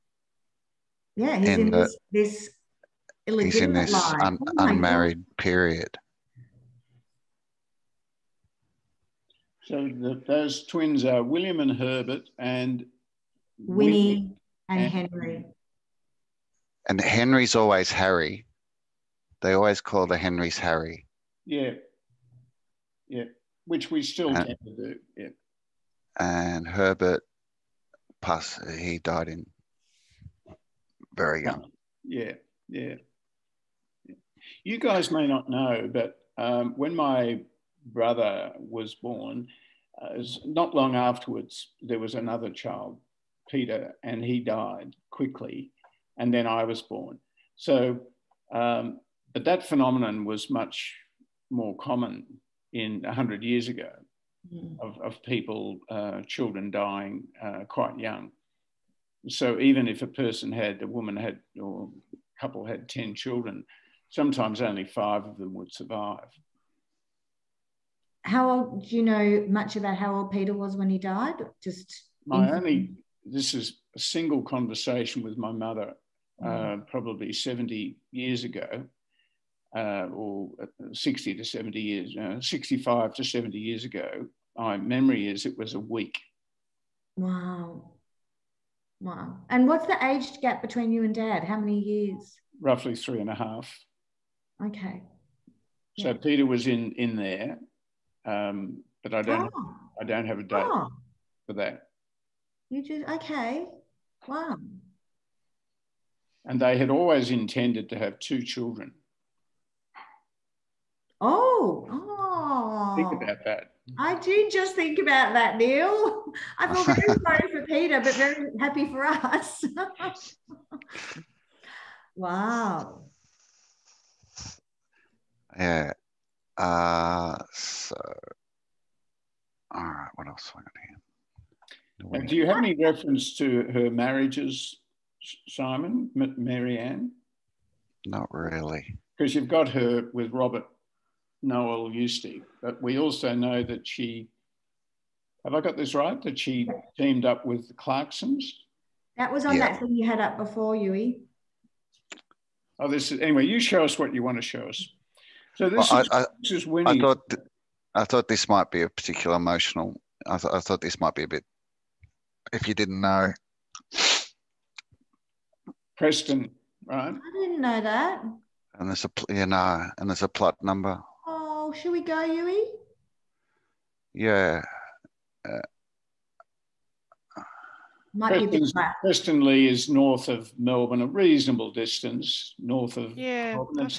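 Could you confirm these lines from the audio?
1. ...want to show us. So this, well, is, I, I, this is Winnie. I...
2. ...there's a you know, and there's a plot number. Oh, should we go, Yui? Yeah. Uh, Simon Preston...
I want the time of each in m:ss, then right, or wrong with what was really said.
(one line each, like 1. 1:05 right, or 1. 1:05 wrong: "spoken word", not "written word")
1. 2:34 right
2. 2:48 wrong: "Might", not "Simon".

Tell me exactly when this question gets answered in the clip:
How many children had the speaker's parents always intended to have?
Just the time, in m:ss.
1:48.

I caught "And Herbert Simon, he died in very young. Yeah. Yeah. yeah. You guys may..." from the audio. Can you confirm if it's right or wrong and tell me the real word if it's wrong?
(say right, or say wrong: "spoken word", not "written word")
wrong: "Puss", not "Simon".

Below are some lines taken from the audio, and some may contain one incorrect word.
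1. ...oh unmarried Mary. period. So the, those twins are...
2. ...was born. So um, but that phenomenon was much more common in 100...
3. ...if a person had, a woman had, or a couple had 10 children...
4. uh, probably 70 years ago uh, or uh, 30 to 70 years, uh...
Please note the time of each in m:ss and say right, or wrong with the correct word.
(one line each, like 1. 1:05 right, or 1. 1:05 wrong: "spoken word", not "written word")
1. 0:04 wrong: "God", not "Mary"
2. 0:46 right
3. 0:59 right
4. 1:16 wrong: "60", not "30".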